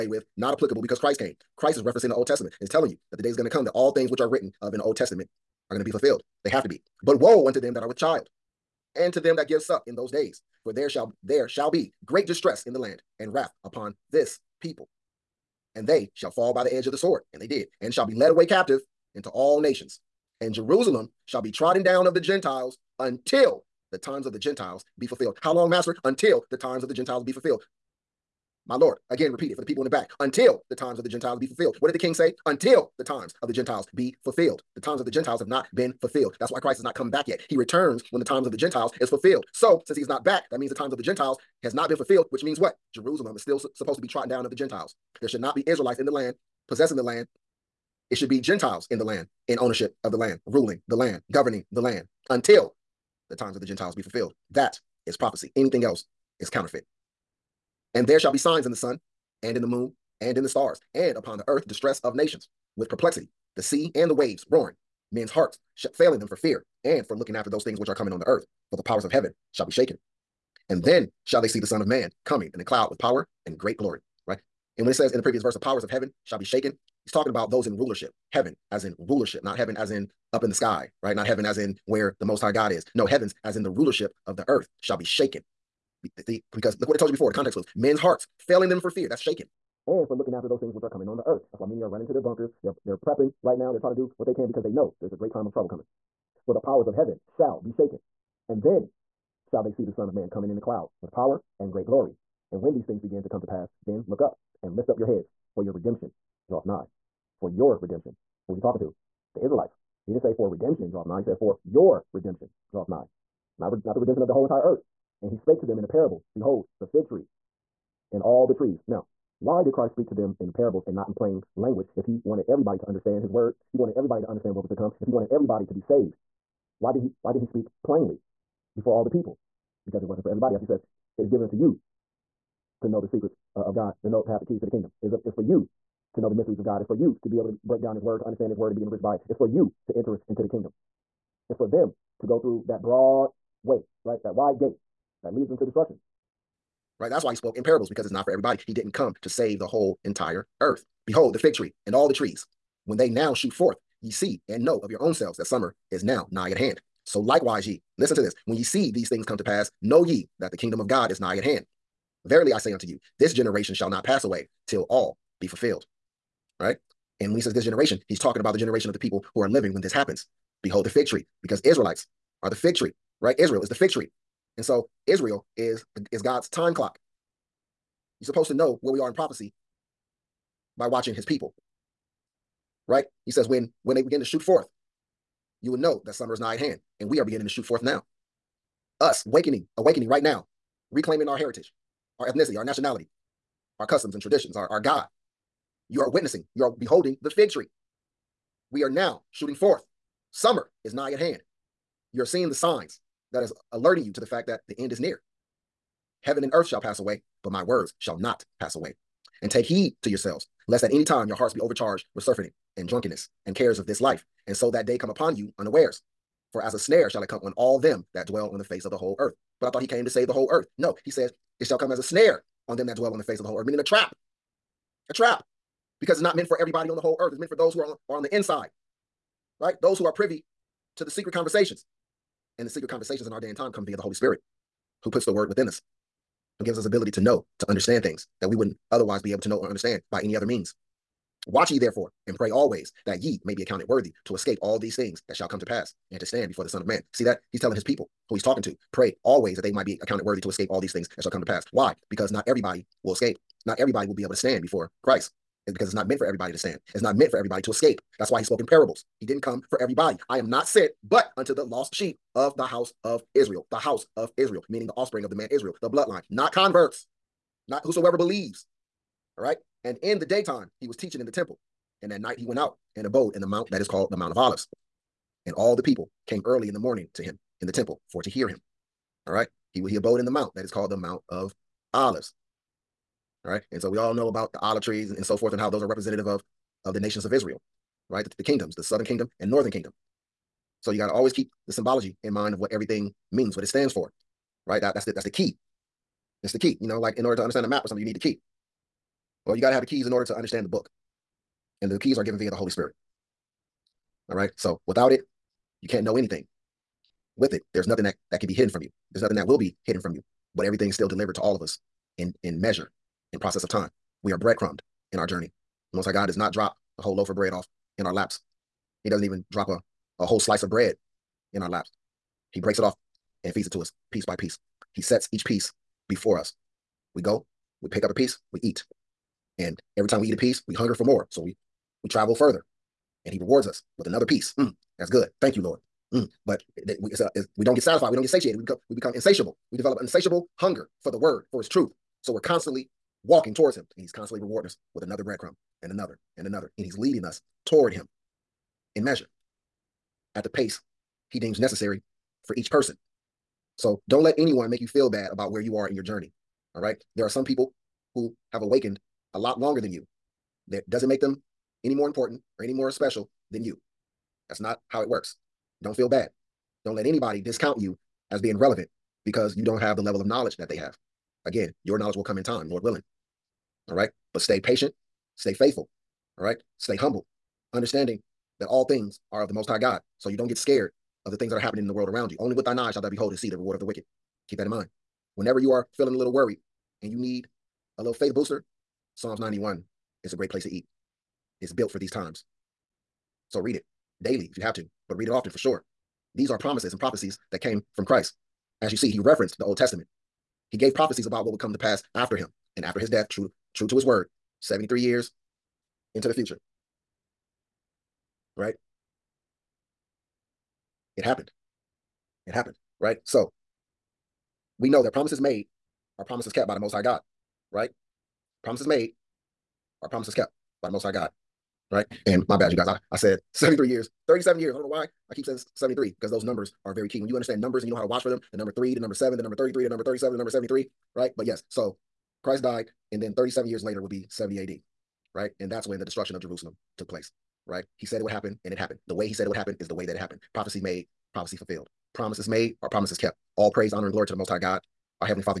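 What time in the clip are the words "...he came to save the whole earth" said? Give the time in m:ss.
3:39.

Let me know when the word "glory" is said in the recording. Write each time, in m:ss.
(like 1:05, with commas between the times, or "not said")
1:13, 1:41, 7:24.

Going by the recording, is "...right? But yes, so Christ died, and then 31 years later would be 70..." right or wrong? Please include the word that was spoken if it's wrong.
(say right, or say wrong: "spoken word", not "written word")
wrong: "37", not "31".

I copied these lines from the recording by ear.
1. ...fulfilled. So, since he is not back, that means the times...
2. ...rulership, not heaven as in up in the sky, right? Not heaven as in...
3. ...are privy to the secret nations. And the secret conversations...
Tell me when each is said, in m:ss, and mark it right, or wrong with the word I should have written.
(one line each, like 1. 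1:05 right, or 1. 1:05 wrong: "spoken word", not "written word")
1. 0:39 right
2. 1:18 right
3. 3:50 wrong: "conversations", not "nations".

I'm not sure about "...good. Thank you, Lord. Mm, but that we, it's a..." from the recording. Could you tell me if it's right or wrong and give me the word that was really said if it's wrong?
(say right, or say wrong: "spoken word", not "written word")
right.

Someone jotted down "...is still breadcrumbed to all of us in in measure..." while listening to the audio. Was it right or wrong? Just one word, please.
wrong.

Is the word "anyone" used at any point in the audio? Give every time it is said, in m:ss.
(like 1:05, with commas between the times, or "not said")
5:54.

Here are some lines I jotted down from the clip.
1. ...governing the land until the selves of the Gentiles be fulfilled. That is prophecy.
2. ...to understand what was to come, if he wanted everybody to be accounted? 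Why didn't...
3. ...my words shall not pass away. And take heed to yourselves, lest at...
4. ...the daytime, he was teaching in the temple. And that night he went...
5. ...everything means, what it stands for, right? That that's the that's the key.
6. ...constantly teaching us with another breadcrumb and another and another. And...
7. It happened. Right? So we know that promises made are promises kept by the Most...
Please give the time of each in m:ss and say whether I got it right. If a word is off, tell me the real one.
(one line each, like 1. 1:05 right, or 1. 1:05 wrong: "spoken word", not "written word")
1. 0:51 wrong: "times", not "selves"
2. 2:04 wrong: "saved", not "accounted"
3. 3:27 right
4. 4:30 right
5. 4:52 right
6. 5:44 wrong: "rewarding", not "teaching"
7. 6:52 right.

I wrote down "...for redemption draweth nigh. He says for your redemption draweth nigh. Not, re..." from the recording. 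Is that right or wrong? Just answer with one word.
right.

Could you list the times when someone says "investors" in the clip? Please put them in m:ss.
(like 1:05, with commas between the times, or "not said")
not said.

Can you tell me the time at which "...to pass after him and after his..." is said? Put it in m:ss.
6:41.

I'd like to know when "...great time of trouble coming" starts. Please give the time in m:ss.
1:35.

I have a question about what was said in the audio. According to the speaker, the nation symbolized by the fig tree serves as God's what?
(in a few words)
time clock.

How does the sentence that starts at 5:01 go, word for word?
And the keys are given via the Holy Spirit.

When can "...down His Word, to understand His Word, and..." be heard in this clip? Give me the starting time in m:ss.
2:17.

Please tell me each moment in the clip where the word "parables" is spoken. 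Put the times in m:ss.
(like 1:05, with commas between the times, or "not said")
1:55, 2:00, 2:27, 4:18.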